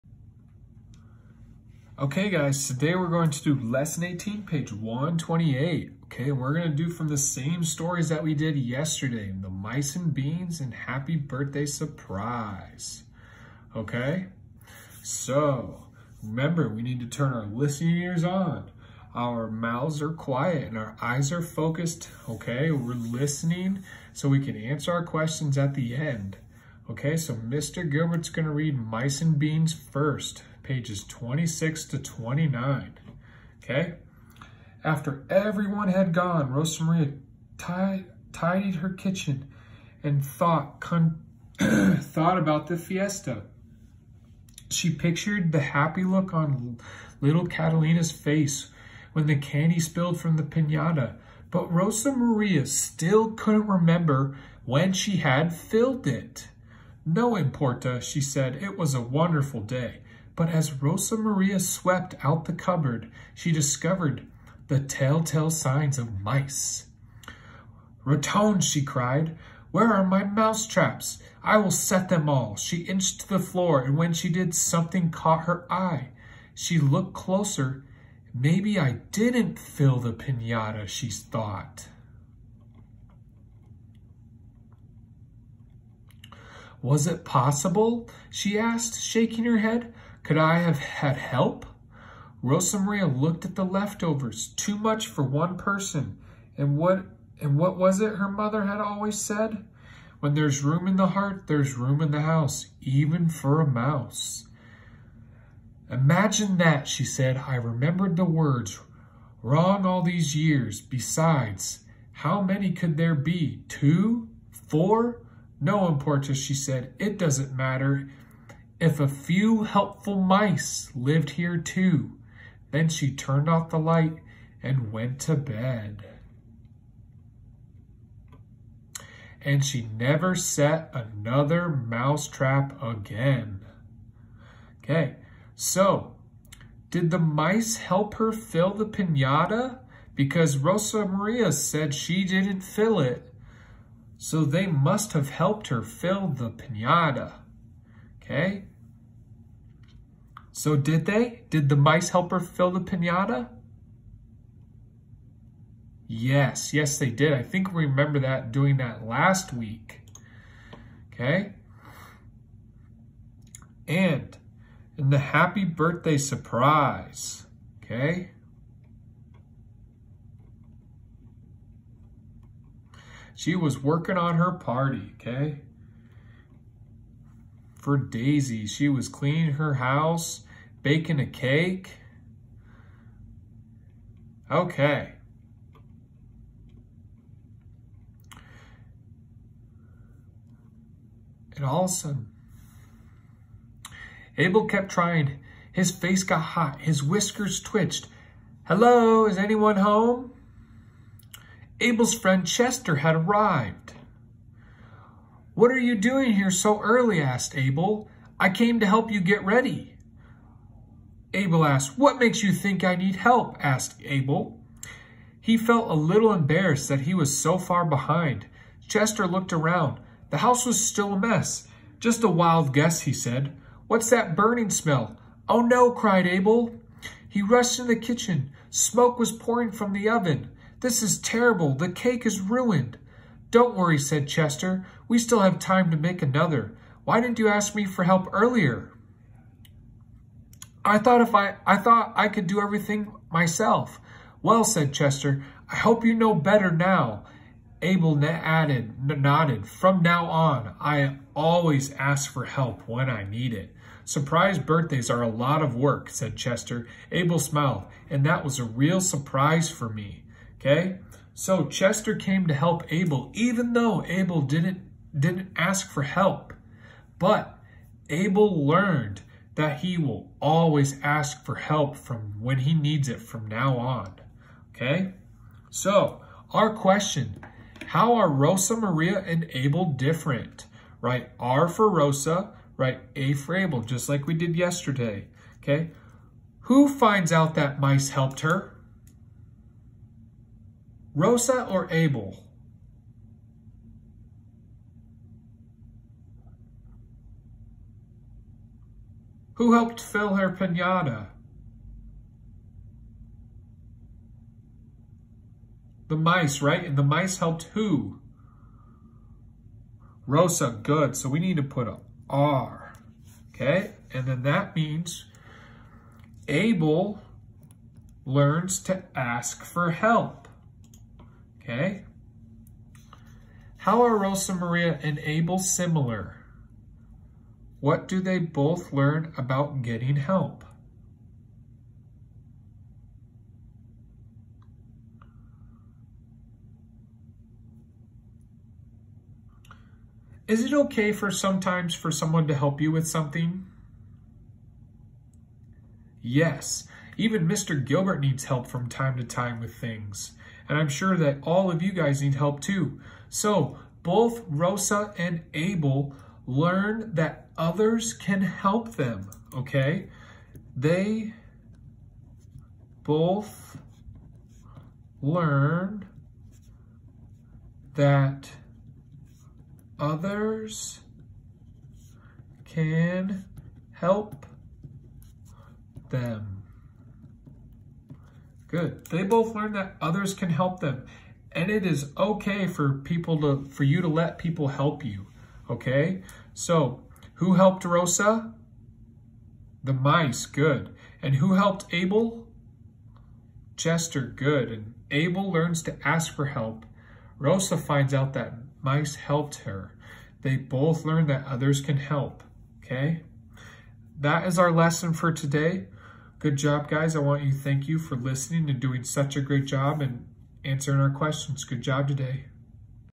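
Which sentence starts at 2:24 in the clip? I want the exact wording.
So they must have helped her fill the pinata.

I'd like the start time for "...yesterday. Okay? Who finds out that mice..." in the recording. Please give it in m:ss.
4:44.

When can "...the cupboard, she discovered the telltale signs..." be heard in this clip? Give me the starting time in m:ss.
1:02.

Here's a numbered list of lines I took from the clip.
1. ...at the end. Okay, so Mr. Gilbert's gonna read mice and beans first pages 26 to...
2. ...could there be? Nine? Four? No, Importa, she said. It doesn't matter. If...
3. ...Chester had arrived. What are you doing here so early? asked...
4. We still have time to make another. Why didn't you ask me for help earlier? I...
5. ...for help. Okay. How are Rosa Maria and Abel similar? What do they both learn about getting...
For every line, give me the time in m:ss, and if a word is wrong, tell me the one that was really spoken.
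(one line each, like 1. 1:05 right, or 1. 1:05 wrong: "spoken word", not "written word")
1. 0:25 right
2. 1:52 wrong: "Two", not "Nine"
3. 3:22 right
4. 3:55 right
5. 5:19 right.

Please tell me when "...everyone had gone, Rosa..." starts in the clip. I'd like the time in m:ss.
0:35.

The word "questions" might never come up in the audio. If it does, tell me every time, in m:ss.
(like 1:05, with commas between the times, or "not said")
0:25, 4:36, 6:51.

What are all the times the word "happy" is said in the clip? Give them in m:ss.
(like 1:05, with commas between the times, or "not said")
0:10, 0:45, 2:45.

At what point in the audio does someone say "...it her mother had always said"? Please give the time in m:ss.
1:38.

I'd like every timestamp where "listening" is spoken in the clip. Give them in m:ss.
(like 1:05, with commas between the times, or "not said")
0:17, 0:22, 6:48.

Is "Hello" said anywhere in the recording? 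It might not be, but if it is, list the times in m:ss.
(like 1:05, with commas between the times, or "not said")
3:18.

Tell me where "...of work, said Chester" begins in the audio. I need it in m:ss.
4:15.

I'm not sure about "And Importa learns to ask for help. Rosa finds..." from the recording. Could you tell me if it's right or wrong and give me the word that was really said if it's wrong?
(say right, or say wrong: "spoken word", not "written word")
wrong: "Abel", not "Importa".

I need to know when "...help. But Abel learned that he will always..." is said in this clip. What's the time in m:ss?
4:26.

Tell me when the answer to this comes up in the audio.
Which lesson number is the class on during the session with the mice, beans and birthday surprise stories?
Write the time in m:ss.
0:03.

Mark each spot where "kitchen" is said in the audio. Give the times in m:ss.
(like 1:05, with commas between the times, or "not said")
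0:38, 3:47.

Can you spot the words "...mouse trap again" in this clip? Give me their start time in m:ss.
2:11.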